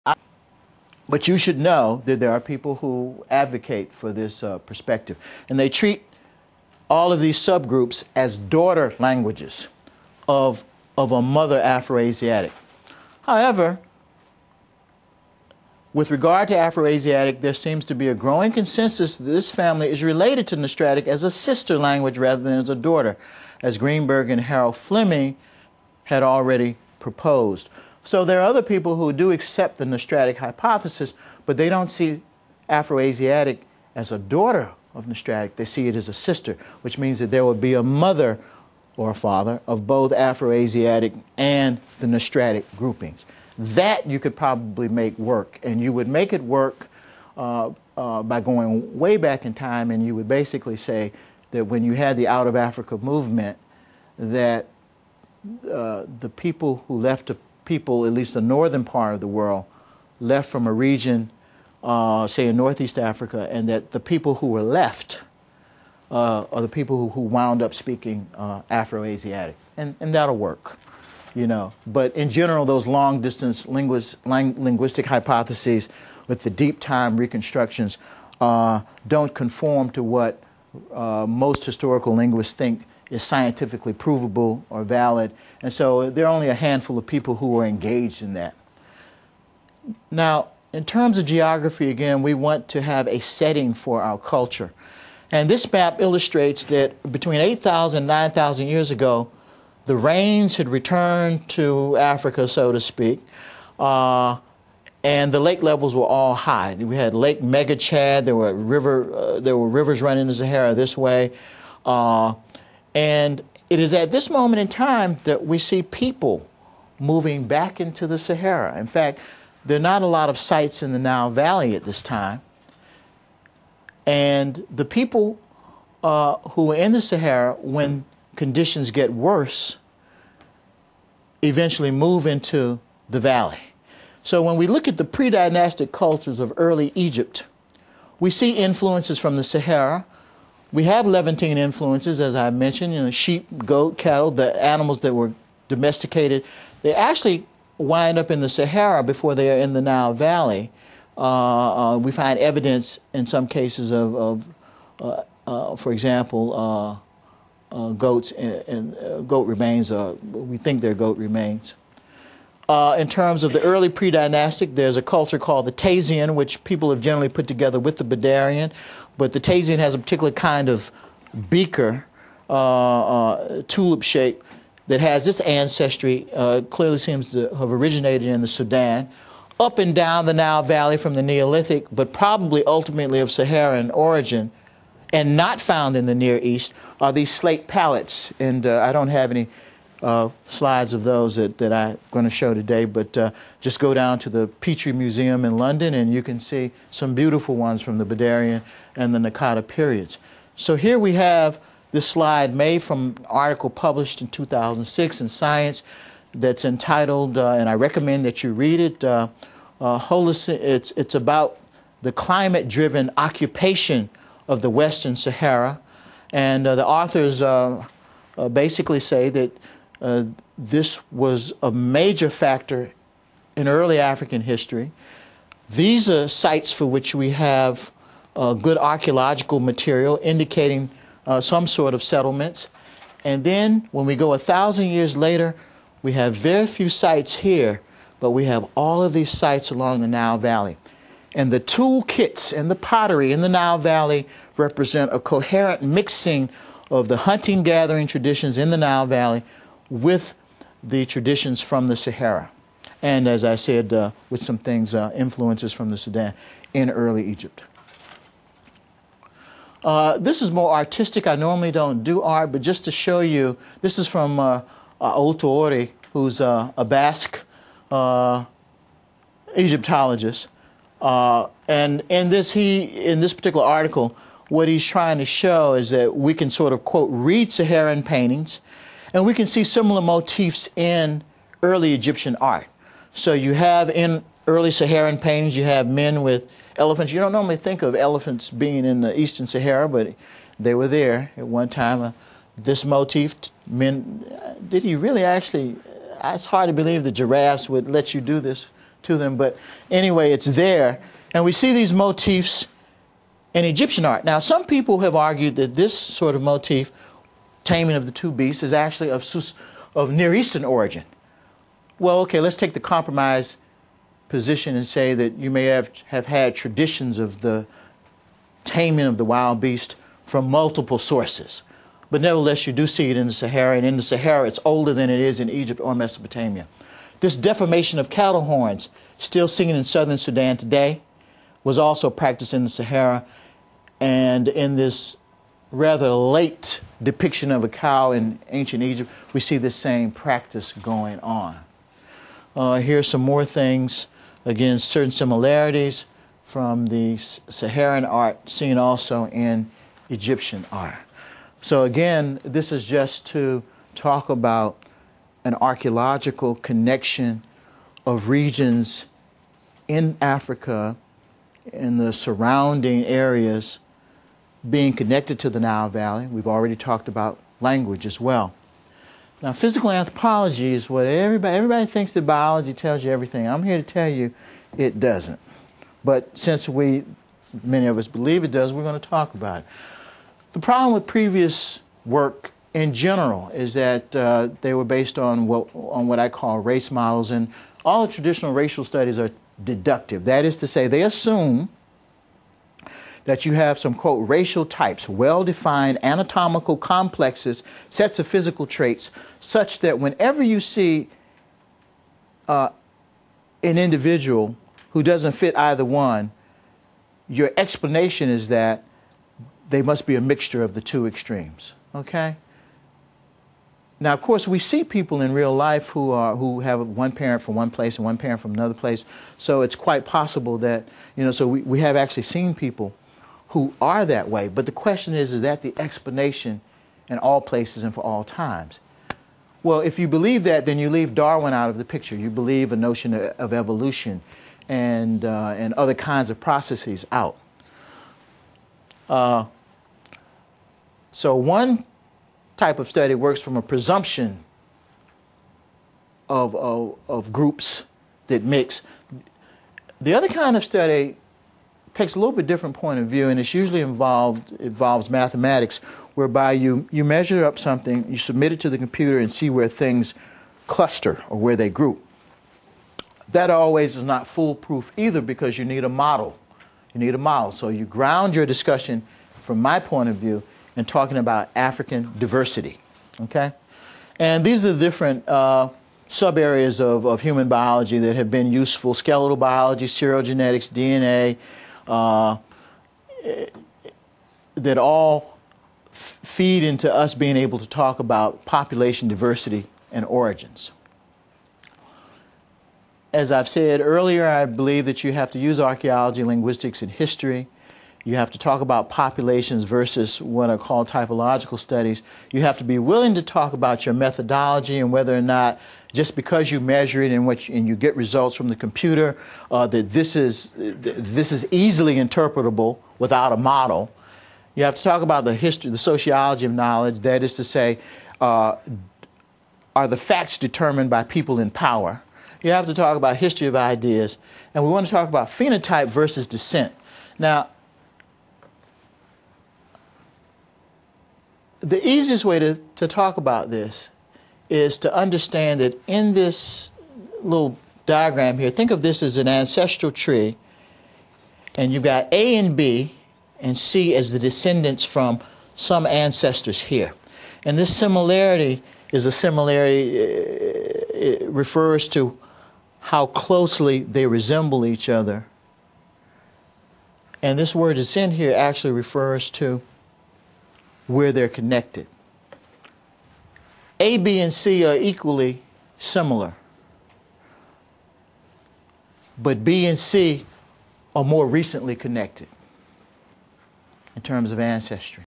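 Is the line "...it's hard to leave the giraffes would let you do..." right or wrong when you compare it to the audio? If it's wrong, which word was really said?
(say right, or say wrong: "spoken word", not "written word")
wrong: "believe", not "leave".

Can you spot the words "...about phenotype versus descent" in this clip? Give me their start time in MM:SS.
08:45.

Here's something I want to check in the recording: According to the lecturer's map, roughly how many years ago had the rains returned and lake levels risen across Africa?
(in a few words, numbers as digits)
8,000 to 9,000 years.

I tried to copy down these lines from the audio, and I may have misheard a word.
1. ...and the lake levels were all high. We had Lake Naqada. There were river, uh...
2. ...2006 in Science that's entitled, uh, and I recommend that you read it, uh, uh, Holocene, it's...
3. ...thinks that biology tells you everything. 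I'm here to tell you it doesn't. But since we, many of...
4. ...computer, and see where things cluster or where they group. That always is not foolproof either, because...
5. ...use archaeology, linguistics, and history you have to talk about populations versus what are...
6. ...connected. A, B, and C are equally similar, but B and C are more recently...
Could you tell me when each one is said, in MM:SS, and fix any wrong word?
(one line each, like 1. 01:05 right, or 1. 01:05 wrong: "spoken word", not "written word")
1. 01:45 wrong: "Megachad", not "Naqada"
2. 03:24 right
3. 06:11 right
4. 07:38 right
5. 08:15 right
6. 09:21 right.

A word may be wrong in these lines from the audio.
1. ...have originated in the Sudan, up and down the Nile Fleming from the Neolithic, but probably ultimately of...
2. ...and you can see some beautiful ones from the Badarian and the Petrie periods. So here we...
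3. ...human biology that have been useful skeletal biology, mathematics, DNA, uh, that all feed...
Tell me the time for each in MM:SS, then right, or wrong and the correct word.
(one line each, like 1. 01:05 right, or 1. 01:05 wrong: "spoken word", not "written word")
1. 02:57 wrong: "Valley", not "Fleming"
2. 03:15 wrong: "Naqada", not "Petrie"
3. 07:57 wrong: "serogenetics", not "mathematics".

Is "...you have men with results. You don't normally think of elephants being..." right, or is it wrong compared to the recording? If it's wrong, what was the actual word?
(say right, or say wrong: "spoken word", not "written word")
wrong: "elephants", not "results".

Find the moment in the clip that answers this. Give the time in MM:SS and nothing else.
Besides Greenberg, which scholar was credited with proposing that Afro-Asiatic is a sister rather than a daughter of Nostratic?
00:24.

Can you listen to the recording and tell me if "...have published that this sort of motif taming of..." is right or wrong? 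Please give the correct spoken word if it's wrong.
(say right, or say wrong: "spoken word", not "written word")
wrong: "argued", not "published".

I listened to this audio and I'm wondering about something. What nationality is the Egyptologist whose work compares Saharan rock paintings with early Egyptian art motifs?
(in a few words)
Basque.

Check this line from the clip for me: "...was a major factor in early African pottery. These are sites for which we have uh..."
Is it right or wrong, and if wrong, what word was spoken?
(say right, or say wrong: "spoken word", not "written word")
wrong: "history", not "pottery".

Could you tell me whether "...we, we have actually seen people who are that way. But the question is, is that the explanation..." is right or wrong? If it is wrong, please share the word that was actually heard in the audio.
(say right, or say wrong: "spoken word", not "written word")
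right.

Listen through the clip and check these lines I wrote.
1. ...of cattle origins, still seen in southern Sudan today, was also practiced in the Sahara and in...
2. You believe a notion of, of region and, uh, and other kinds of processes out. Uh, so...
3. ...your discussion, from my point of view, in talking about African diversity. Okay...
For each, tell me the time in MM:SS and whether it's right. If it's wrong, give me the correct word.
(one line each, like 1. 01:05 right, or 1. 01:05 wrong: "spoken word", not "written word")
1. 05:27 wrong: "horns", not "origins"
2. 07:12 wrong: "evolution", not "region"
3. 07:48 right.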